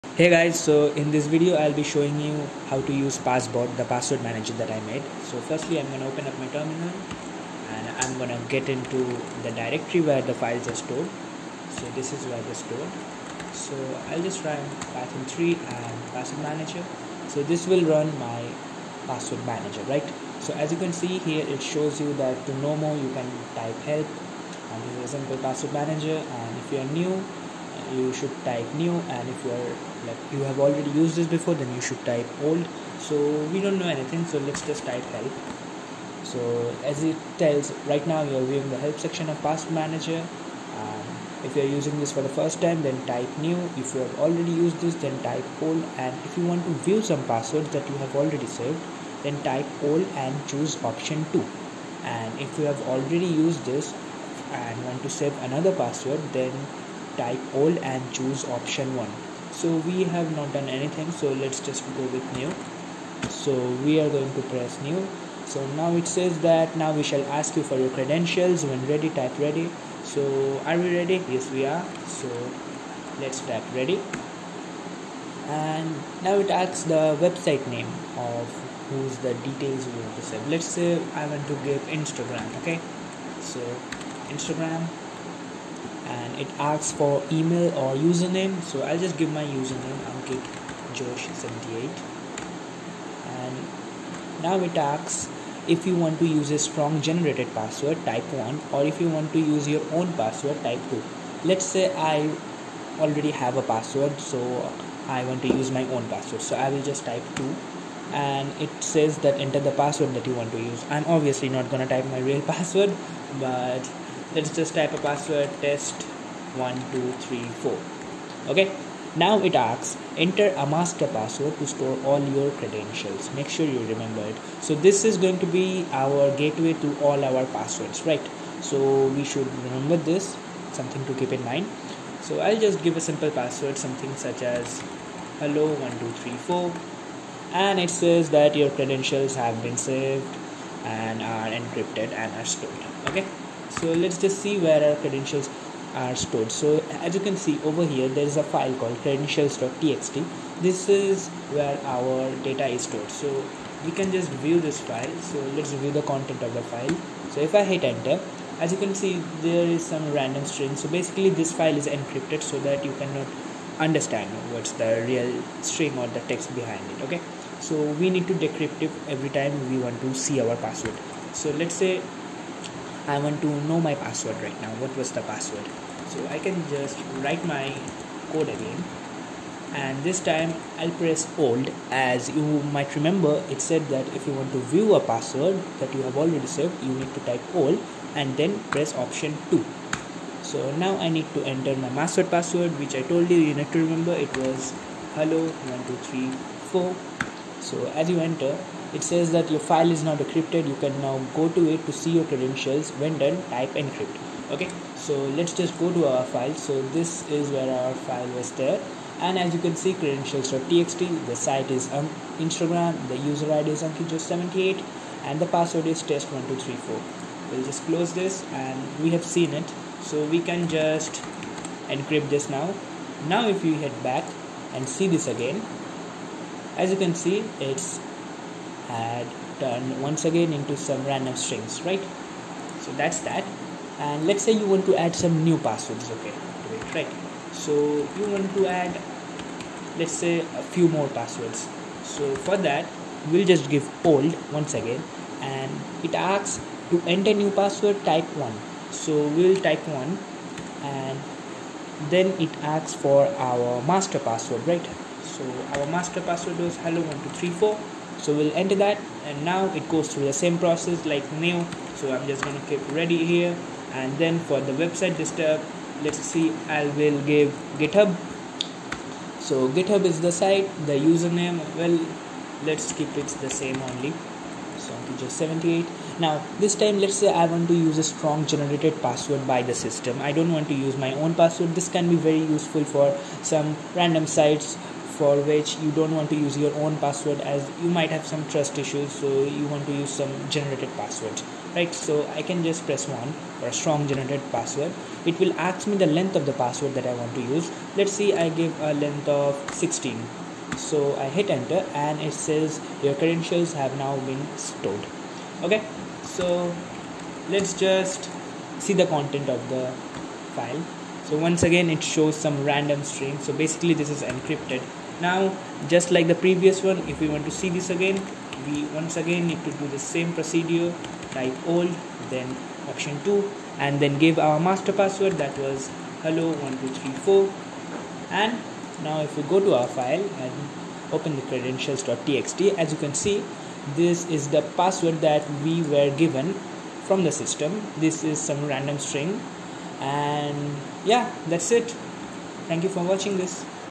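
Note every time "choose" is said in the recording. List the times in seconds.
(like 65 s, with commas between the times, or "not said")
50 s, 58 s.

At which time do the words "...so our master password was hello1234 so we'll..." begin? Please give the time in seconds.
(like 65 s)
255 s.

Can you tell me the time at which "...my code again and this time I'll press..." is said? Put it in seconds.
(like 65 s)
177 s.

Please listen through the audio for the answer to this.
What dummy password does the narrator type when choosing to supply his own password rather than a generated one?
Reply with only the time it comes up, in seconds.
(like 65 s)
115 s.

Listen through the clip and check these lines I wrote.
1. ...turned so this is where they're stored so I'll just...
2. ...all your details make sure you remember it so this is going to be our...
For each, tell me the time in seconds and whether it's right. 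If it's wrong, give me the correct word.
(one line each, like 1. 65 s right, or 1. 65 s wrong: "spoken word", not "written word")
1. 10 s wrong: "stored", not "turned"
2. 122 s wrong: "credentials", not "details".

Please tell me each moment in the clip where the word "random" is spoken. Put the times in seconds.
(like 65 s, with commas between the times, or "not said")
160 s, 231 s, 283 s, 312 s, 338 s.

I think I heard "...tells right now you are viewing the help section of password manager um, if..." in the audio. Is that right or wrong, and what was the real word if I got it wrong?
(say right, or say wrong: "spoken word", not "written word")
right.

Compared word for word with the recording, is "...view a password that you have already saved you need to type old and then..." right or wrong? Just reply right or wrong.
right.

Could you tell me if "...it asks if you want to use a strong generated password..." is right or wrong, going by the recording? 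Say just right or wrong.
right.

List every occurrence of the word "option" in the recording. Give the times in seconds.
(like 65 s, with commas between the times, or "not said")
50 s, 58 s, 188 s, 322 s.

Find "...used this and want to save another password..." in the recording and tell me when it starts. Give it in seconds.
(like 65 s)
53 s.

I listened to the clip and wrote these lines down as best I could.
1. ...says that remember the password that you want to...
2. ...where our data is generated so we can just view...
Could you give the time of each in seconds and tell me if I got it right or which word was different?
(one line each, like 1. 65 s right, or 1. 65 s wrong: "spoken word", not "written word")
1. 108 s wrong: "enter", not "remember"
2. 151 s wrong: "stored", not "generated".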